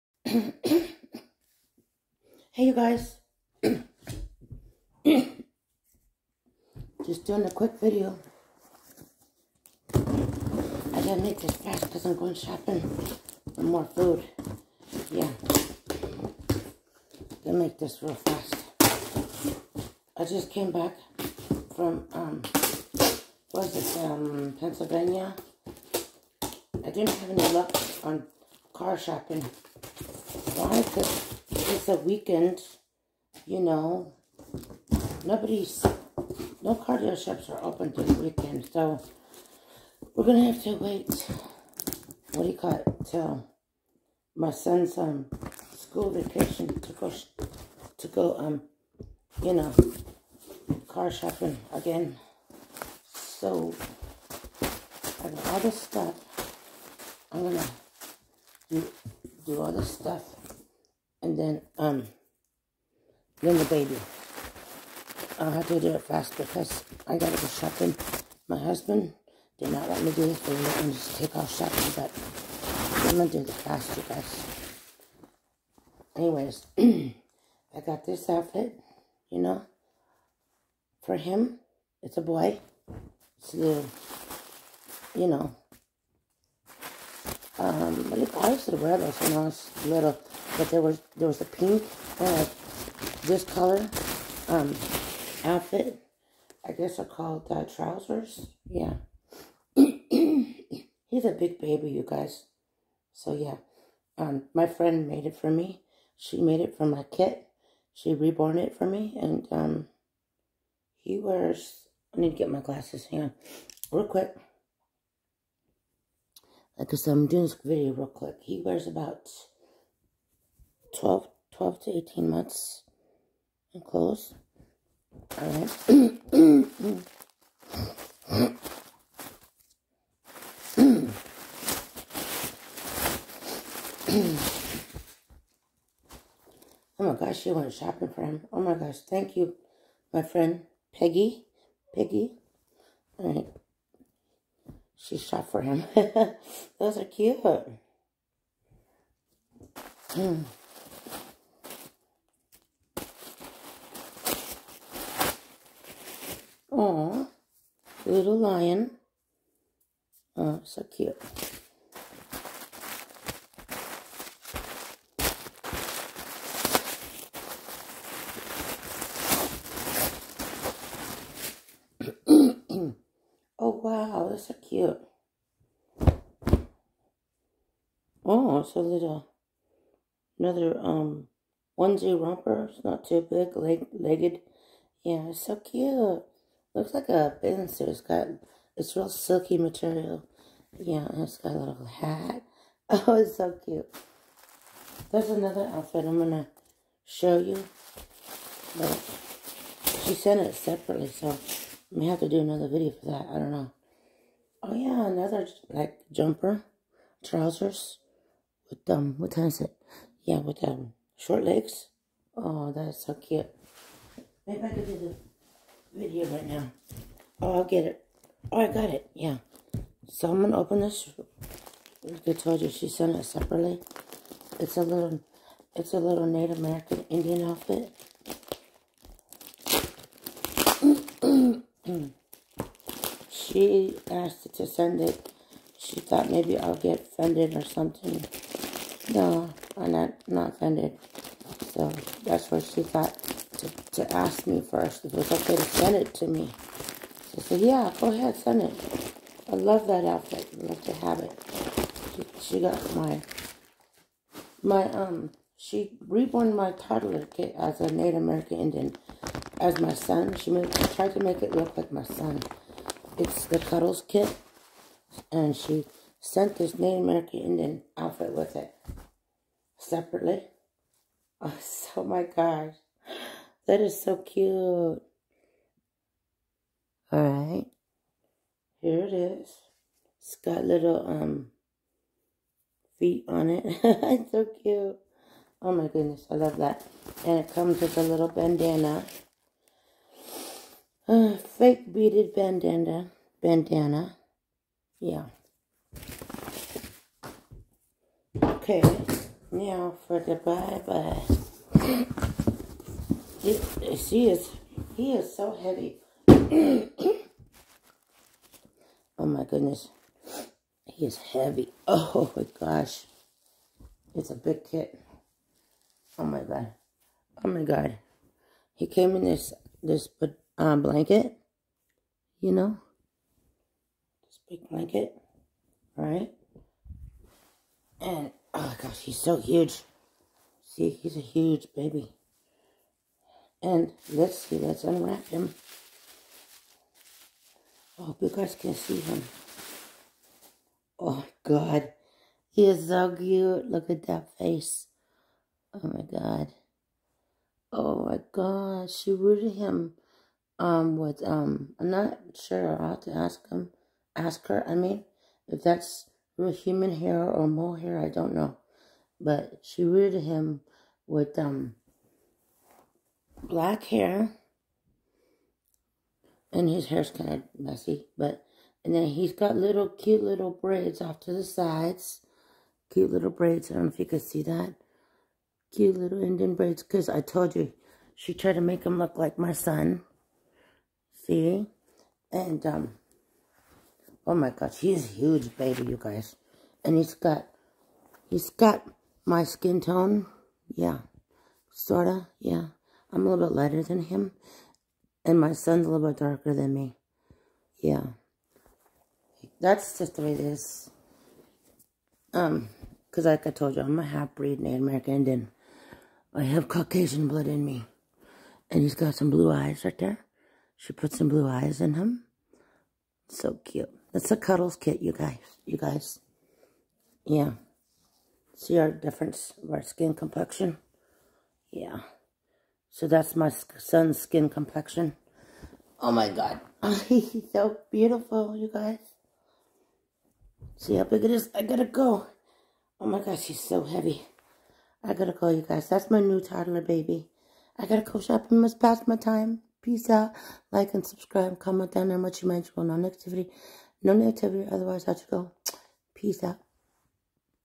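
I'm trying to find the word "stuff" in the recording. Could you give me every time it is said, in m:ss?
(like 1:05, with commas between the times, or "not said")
0:55, 0:59.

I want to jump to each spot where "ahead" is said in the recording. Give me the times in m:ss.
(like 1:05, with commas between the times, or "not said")
4:08.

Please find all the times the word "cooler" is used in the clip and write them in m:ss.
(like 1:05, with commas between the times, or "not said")
not said.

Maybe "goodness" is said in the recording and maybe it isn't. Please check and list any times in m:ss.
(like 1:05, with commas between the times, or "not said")
4:45, 5:09.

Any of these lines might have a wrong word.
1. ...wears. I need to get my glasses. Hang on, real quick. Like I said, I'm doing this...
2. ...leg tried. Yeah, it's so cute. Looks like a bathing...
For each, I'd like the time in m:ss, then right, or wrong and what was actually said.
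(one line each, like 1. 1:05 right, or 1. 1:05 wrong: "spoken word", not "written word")
1. 1:51 right
2. 3:03 wrong: "legged", not "tried".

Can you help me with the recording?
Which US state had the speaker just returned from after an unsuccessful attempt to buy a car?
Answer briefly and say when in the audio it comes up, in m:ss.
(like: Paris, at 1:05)
Pennsylvania, at 0:24.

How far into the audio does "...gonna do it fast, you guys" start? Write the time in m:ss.
1:13.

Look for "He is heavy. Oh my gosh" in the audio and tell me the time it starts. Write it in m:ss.
5:10.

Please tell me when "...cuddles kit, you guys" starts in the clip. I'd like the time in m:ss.
6:54.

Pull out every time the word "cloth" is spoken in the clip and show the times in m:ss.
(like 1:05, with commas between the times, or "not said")
not said.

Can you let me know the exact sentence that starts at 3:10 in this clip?
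Yeah, and it's got a little hat.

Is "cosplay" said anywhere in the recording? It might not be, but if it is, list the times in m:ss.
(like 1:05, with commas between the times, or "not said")
not said.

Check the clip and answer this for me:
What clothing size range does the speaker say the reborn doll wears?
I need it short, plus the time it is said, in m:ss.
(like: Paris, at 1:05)
12 to 18 months, at 2:01.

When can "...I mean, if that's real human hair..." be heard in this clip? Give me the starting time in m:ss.
5:54.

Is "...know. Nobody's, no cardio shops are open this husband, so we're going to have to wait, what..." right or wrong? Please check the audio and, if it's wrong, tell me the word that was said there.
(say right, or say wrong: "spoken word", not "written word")
wrong: "weekend", not "husband".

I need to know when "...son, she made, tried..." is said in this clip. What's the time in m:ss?
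4:19.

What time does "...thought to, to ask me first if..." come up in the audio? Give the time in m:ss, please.
4:02.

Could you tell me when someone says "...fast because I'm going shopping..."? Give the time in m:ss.
0:11.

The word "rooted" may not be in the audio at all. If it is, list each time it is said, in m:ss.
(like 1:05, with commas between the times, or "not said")
5:49, 5:59.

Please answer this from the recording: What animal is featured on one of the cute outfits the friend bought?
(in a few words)
Lion.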